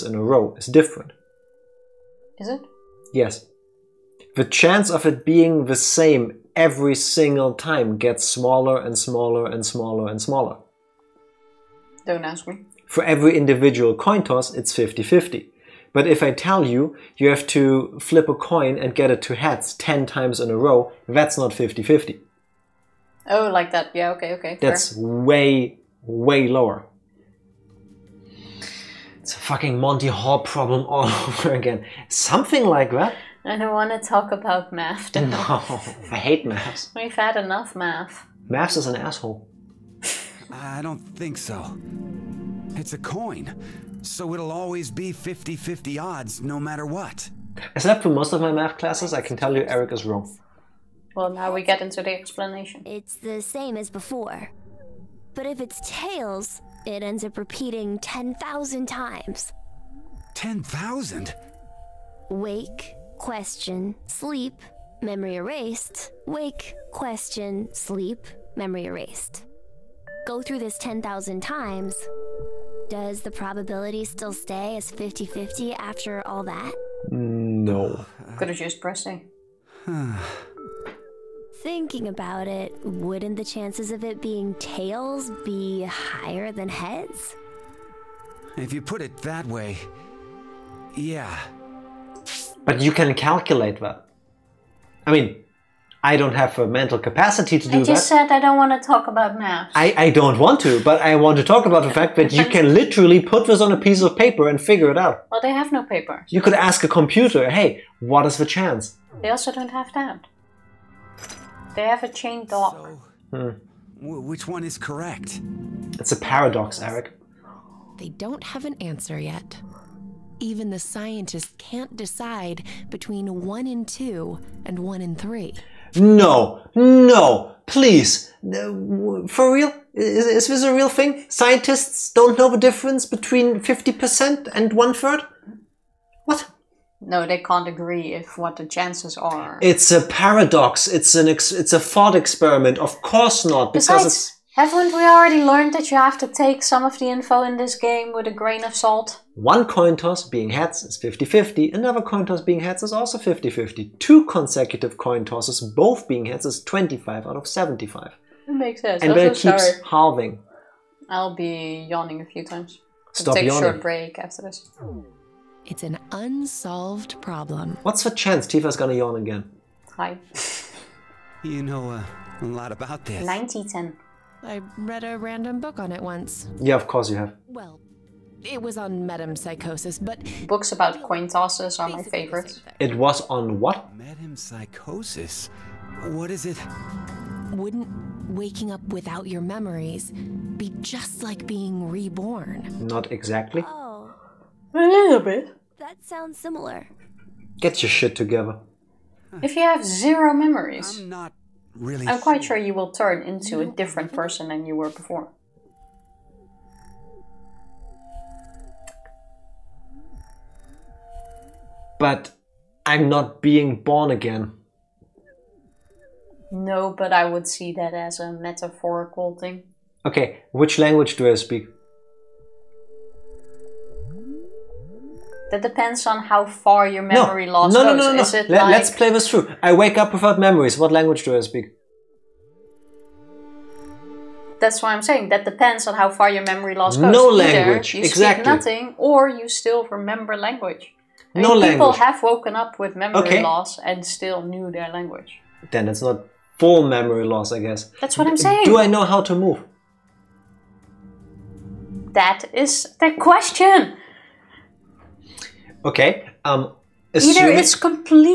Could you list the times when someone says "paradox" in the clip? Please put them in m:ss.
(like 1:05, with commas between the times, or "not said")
1:56, 2:20.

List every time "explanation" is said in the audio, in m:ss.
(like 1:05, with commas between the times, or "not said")
0:52.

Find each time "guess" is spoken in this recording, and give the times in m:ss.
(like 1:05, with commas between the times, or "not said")
4:07.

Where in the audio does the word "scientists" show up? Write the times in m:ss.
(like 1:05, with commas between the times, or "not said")
2:00, 2:11.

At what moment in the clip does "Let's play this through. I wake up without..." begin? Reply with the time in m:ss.
3:48.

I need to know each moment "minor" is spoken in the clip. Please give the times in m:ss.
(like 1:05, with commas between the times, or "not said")
not said.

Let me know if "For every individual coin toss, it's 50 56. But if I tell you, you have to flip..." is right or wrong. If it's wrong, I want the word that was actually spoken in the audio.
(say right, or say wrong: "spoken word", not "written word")
wrong: "50", not "56".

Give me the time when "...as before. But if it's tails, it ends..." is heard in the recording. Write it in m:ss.
0:53.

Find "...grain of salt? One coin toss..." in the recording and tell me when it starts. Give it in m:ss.
2:28.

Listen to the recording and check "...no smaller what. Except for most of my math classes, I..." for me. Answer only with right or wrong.
wrong.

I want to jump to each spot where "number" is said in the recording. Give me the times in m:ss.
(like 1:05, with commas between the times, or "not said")
not said.